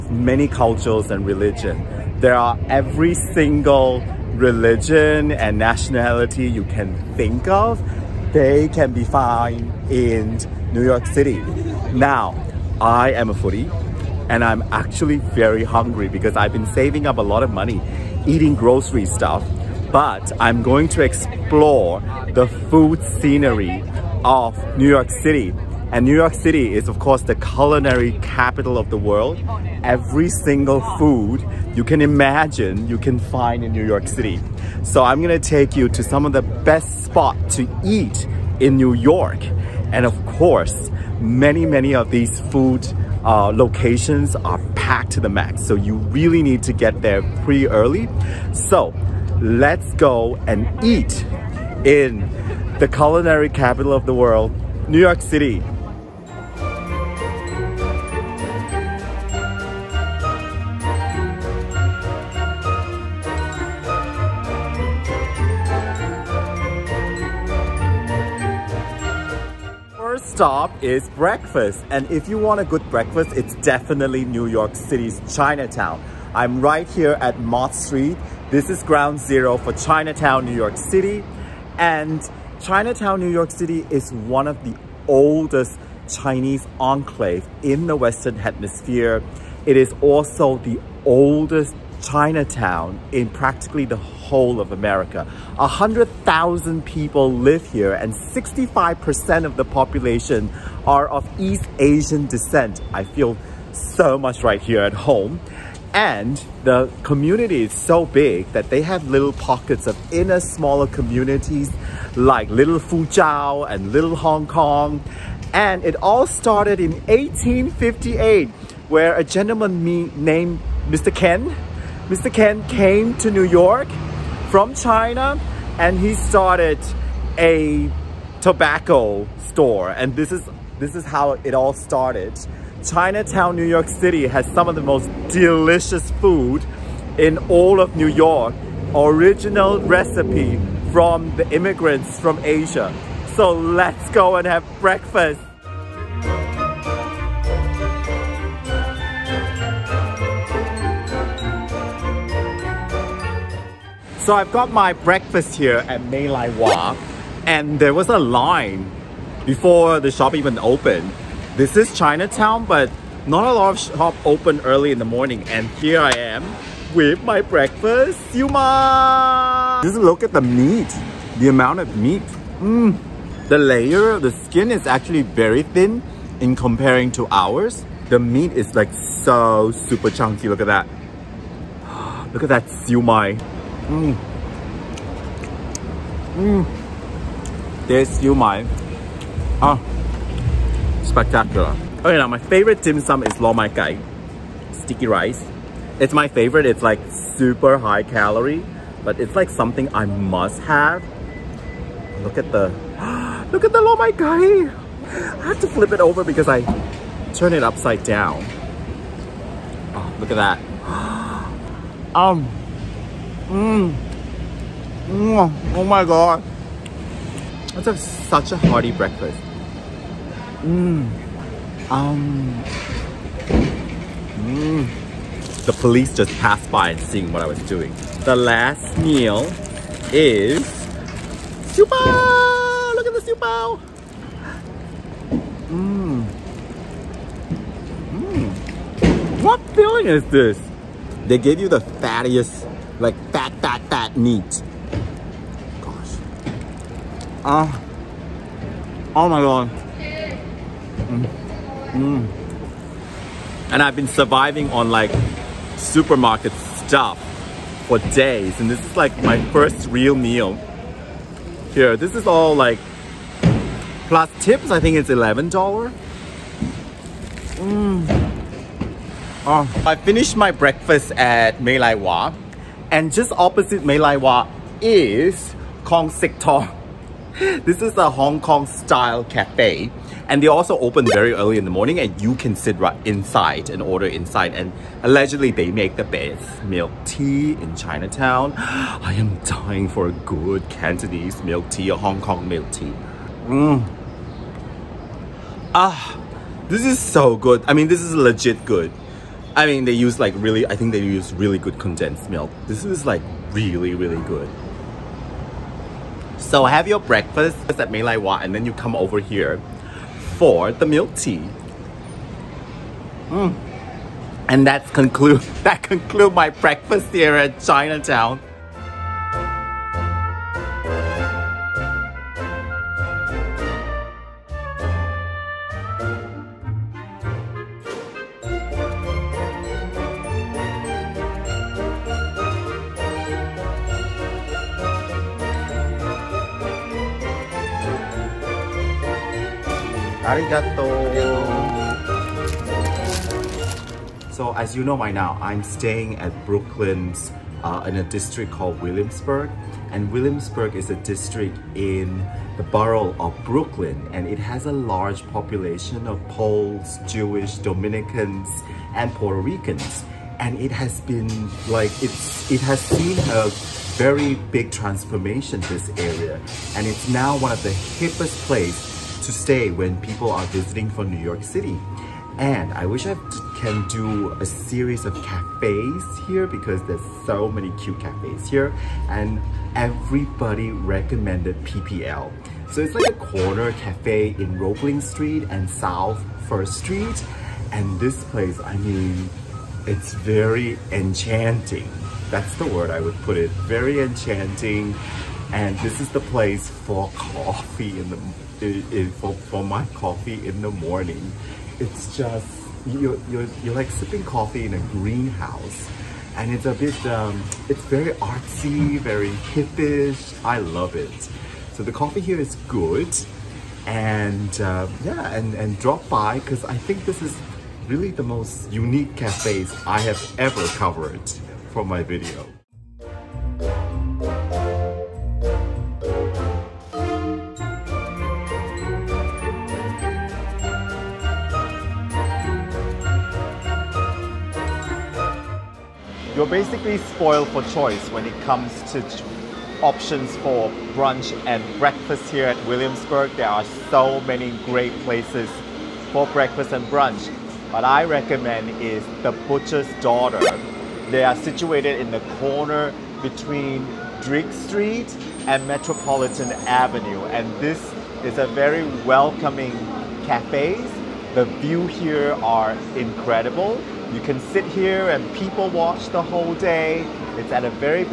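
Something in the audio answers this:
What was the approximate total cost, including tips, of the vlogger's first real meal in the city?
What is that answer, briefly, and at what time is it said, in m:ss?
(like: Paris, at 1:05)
$11, at 4:25.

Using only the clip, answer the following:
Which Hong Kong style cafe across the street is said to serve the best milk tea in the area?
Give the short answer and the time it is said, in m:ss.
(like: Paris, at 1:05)
Kong Sihk Tong, at 4:35.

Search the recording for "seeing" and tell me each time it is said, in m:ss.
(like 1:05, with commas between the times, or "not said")
3:46.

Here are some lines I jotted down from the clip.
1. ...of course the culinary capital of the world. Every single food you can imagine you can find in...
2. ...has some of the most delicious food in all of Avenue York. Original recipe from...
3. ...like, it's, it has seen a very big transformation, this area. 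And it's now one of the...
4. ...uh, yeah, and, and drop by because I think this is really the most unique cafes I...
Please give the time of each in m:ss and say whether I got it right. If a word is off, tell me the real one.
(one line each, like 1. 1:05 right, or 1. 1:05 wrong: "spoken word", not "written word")
1. 0:26 right
2. 2:14 wrong: "New", not "Avenue"
3. 6:01 right
4. 6:54 right.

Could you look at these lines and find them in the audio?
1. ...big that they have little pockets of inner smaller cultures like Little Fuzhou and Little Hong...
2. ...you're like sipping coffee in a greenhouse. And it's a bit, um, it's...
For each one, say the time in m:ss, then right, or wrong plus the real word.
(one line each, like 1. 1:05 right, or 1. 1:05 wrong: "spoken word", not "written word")
1. 1:48 wrong: "communities", not "cultures"
2. 6:43 right.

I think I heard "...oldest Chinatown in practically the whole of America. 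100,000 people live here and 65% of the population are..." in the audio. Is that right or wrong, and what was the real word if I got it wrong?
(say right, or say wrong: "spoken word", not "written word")
right.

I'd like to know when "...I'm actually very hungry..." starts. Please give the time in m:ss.
0:14.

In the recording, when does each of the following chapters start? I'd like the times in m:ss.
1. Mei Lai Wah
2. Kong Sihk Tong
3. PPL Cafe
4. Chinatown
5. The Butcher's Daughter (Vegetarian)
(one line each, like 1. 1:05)
1. 2:34
2. 4:31
3. 5:29
4. 0:56
5. 7:02.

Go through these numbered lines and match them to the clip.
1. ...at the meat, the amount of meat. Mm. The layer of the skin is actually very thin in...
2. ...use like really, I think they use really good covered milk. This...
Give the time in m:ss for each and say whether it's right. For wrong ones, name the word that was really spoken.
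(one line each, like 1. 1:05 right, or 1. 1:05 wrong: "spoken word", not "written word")
1. 2:50 right
2. 4:59 wrong: "condensed", not "covered".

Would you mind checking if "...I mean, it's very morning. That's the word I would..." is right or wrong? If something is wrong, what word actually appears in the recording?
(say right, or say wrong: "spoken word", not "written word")
wrong: "enchanting", not "morning".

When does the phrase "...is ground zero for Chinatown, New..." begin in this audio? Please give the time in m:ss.
1:18.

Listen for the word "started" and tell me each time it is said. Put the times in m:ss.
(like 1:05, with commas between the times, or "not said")
1:56, 2:06, 2:11.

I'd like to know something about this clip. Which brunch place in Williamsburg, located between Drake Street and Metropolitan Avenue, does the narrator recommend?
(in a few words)
The Butcher's Daughter.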